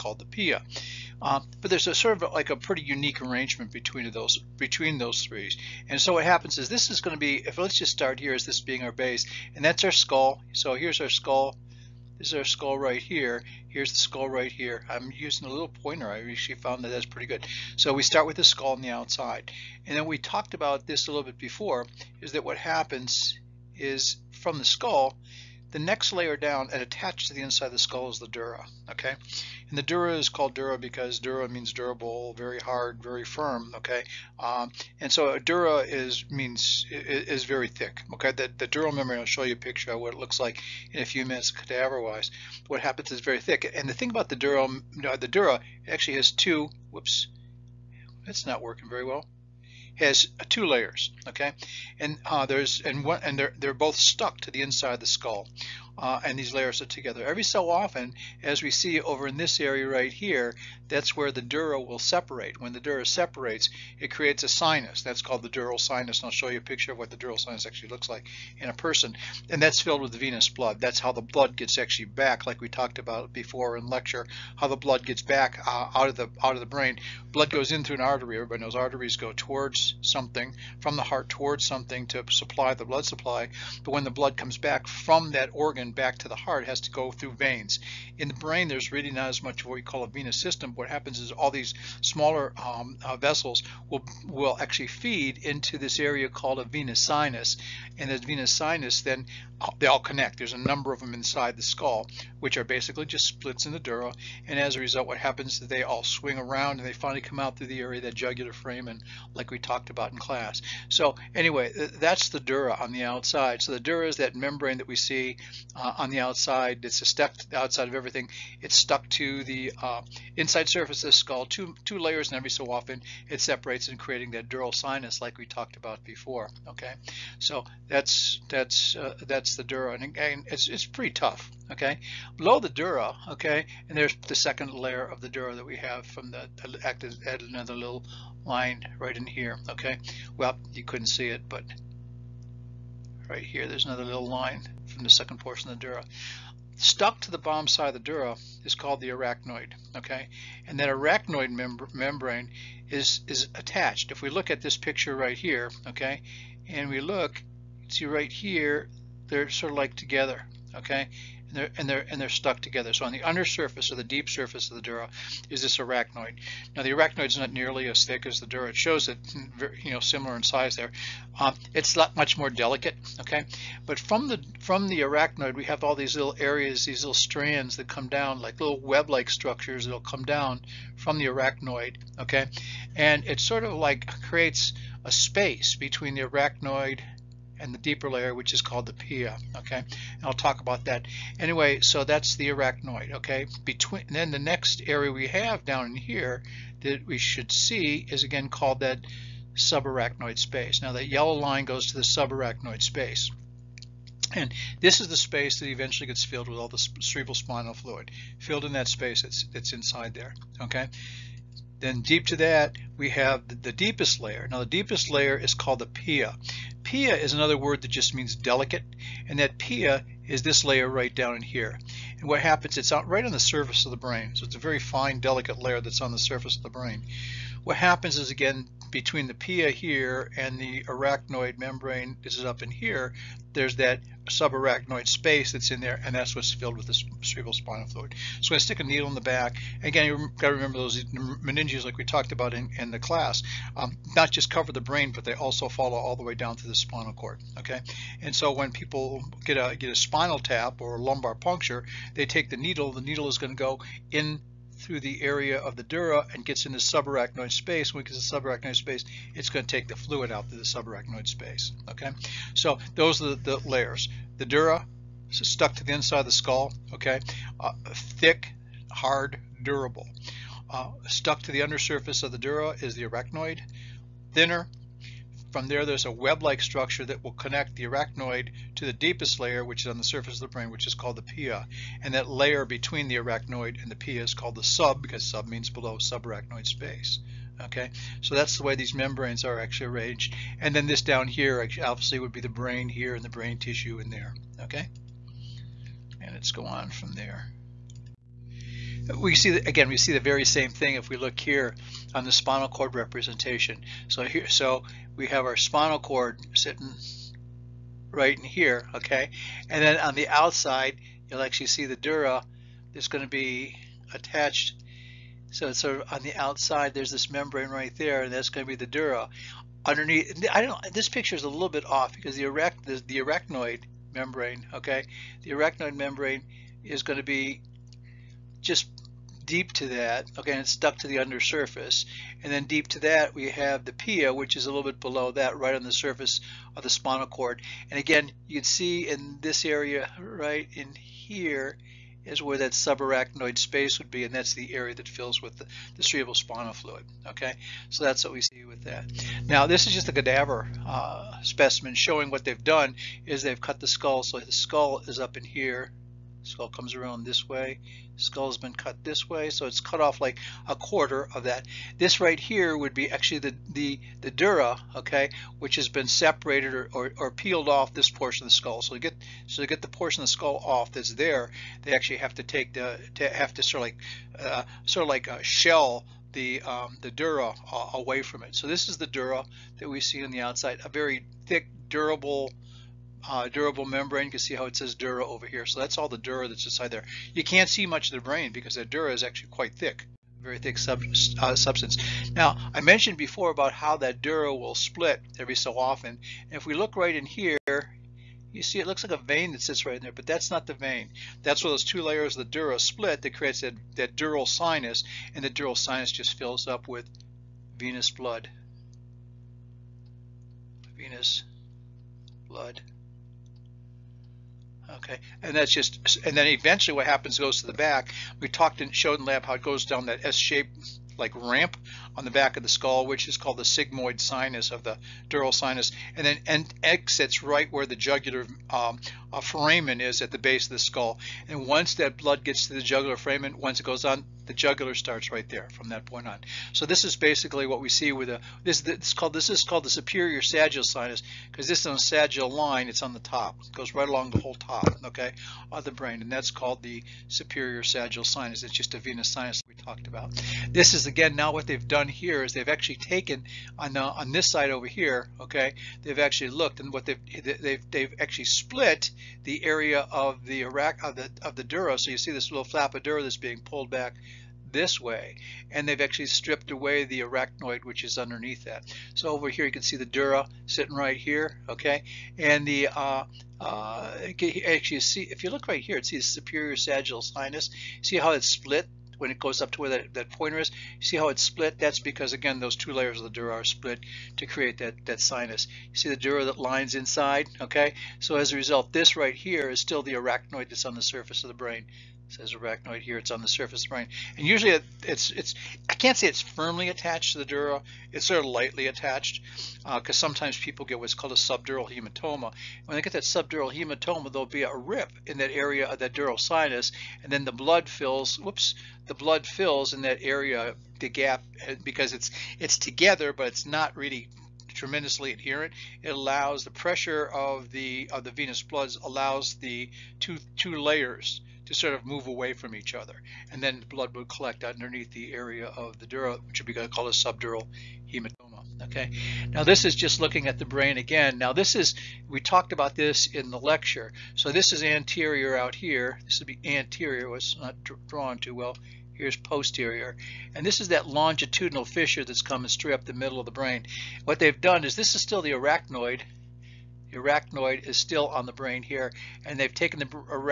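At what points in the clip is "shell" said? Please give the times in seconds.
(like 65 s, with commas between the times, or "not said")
375 s.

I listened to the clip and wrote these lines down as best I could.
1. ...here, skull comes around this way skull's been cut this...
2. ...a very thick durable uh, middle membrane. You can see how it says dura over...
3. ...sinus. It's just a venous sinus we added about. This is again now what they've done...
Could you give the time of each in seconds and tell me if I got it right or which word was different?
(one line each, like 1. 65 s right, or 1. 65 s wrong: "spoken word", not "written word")
1. 355 s right
2. 380 s wrong: "durable", not "middle"
3. 448 s wrong: "talked", not "added".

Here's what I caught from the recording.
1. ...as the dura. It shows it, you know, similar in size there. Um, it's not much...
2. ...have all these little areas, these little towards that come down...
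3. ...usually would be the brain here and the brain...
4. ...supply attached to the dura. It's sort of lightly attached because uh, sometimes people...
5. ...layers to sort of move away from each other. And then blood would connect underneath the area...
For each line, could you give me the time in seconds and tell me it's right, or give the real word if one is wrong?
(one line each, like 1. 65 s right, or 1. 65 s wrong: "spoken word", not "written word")
1. 168 s right
2. 175 s wrong: "strands", not "towards"
3. 291 s wrong: "obviously", not "usually"
4. 496 s wrong: "firmly", not "supply"
5. 520 s wrong: "collect", not "connect".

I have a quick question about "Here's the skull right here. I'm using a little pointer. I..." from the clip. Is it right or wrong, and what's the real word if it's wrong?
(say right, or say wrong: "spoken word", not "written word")
right.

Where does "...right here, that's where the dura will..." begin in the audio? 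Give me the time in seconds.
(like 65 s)
59 s.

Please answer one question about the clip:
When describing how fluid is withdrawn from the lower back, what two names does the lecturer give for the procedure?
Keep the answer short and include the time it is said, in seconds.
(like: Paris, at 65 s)
spinal tap or lumbar puncture, at 249 s.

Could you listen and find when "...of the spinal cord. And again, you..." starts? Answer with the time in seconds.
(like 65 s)
336 s.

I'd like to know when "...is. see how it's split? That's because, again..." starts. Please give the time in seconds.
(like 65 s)
480 s.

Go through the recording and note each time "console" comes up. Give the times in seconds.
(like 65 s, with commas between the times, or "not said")
not said.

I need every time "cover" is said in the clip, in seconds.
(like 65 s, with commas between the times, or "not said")
244 s.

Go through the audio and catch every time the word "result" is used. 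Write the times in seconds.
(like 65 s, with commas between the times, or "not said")
104 s, 488 s.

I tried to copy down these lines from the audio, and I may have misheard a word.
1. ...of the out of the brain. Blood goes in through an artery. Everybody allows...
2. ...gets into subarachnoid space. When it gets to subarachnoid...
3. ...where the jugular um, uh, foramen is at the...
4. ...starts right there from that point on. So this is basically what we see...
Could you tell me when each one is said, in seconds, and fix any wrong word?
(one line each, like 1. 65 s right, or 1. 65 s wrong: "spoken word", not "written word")
1. 76 s wrong: "knows", not "allows"
2. 256 s right
3. 427 s right
4. 434 s right.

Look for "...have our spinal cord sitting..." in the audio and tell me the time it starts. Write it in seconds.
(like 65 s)
305 s.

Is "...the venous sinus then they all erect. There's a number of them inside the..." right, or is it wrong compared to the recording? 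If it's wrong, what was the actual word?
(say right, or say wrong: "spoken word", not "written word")
wrong: "connect", not "erect".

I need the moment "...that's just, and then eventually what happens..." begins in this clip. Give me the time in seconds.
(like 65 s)
415 s.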